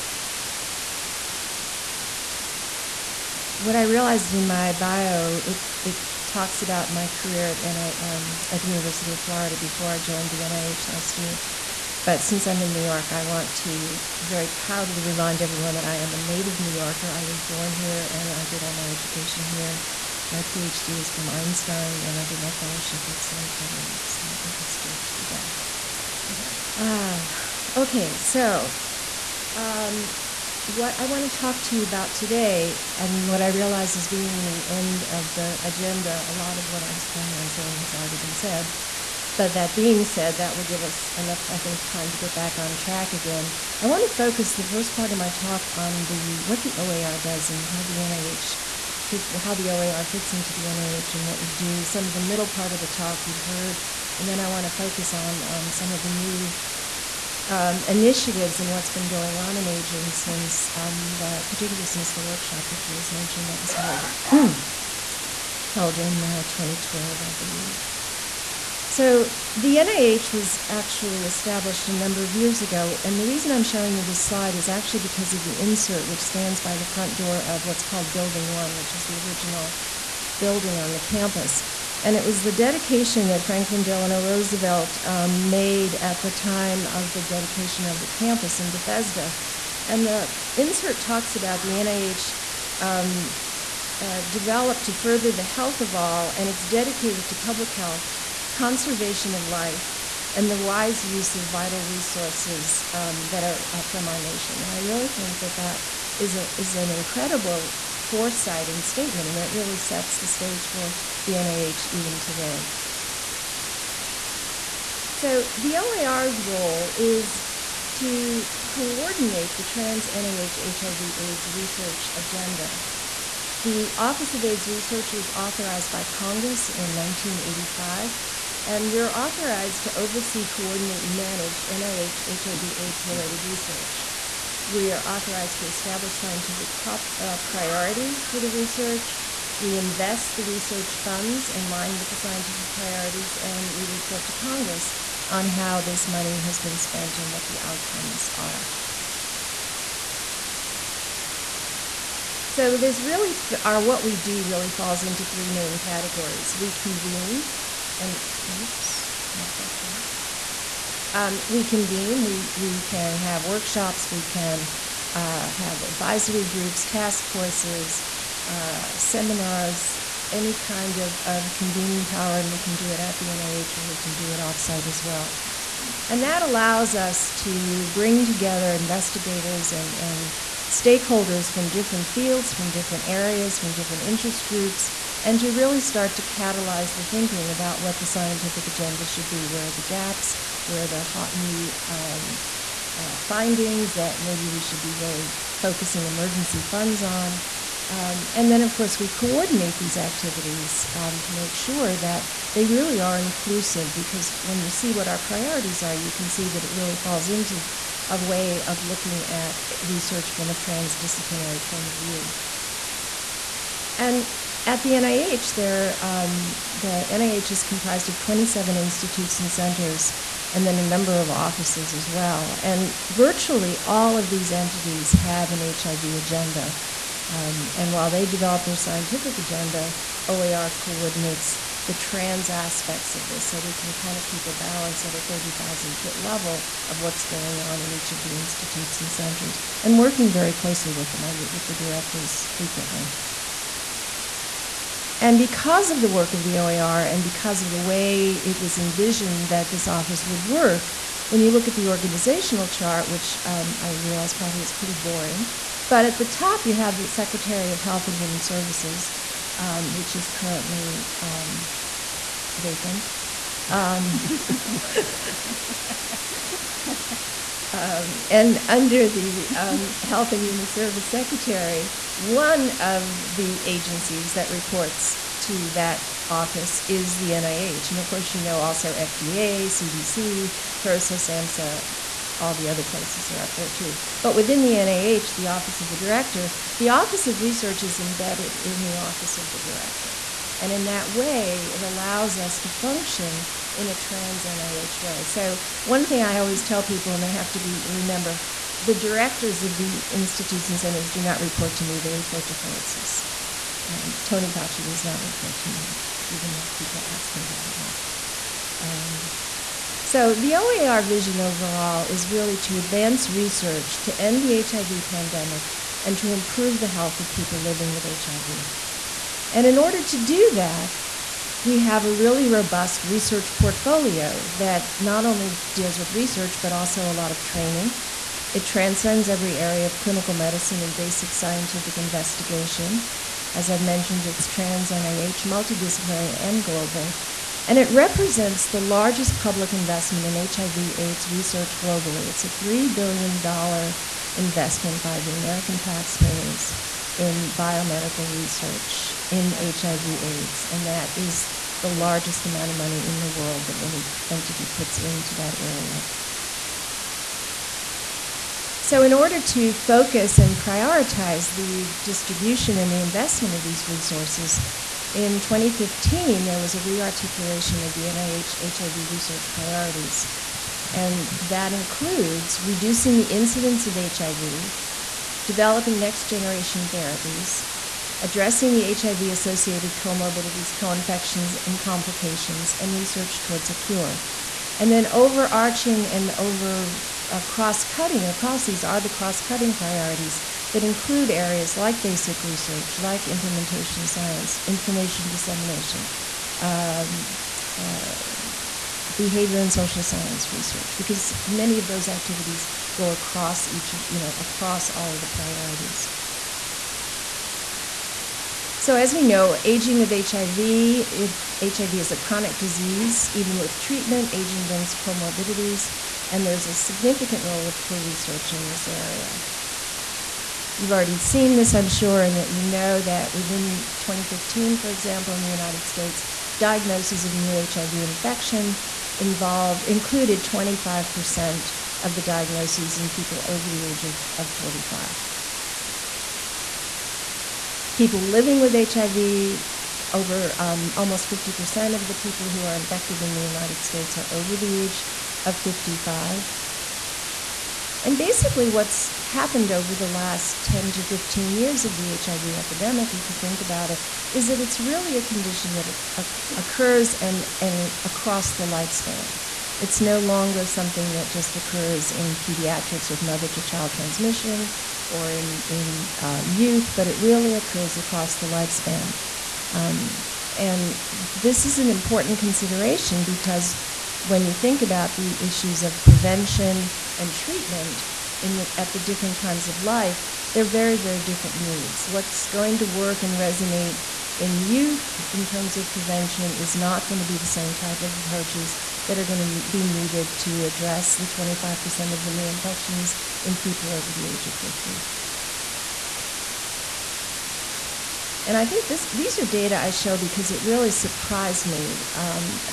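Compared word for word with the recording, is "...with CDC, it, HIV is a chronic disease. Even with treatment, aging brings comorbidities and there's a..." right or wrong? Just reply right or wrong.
wrong.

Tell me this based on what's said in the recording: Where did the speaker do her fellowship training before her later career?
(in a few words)
Sloan Kettering.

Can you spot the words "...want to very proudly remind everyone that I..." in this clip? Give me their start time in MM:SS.
00:13.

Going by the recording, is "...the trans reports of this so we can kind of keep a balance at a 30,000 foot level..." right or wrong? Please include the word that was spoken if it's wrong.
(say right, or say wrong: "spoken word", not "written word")
wrong: "aspects", not "reports".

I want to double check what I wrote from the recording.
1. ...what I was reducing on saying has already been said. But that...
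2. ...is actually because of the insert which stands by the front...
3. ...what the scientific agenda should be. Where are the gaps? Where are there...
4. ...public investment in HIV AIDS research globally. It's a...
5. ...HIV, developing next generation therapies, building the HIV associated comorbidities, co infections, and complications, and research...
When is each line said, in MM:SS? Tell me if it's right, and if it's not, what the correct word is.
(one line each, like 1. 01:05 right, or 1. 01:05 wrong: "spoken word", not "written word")
1. 00:36 wrong: "planning", not "reducing"
2. 01:14 right
3. 03:07 right
4. 05:39 right
5. 06:13 wrong: "addressing", not "building".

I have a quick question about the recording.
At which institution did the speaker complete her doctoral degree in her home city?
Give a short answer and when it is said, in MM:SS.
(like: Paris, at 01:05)
Einstein, at 00:21.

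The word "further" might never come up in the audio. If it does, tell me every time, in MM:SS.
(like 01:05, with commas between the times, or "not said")
01:34.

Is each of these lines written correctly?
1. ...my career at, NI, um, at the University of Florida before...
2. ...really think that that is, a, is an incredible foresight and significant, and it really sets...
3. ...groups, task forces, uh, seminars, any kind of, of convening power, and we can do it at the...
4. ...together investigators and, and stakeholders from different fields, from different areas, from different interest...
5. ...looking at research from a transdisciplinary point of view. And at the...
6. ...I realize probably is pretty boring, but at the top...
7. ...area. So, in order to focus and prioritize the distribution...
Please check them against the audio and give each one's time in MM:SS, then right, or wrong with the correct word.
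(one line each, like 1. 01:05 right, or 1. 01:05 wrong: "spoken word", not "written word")
1. 00:06 right
2. 01:44 wrong: "statement", not "significant"
3. 02:46 right
4. 02:58 right
5. 03:28 right
6. 04:13 right
7. 05:55 right.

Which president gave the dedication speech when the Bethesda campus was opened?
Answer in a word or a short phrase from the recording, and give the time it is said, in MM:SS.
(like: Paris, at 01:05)
Franklin Delano Roosevelt, at 01:23.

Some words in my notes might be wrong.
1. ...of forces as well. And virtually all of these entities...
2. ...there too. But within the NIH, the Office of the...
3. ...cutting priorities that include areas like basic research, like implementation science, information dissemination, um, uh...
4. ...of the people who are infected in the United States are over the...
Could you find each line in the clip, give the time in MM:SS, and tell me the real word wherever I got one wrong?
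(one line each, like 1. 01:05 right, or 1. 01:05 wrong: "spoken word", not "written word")
1. 03:41 wrong: "offices", not "forces"
2. 04:43 right
3. 06:29 right
4. 07:21 right.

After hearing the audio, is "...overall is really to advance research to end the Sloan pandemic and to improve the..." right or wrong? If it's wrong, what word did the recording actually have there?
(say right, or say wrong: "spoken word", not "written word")
wrong: "HIV", not "Sloan".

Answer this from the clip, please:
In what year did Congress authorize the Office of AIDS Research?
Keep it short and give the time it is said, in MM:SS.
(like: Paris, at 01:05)
1985, at 02:06.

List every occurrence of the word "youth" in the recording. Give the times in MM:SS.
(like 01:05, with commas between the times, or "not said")
07:46, 08:04.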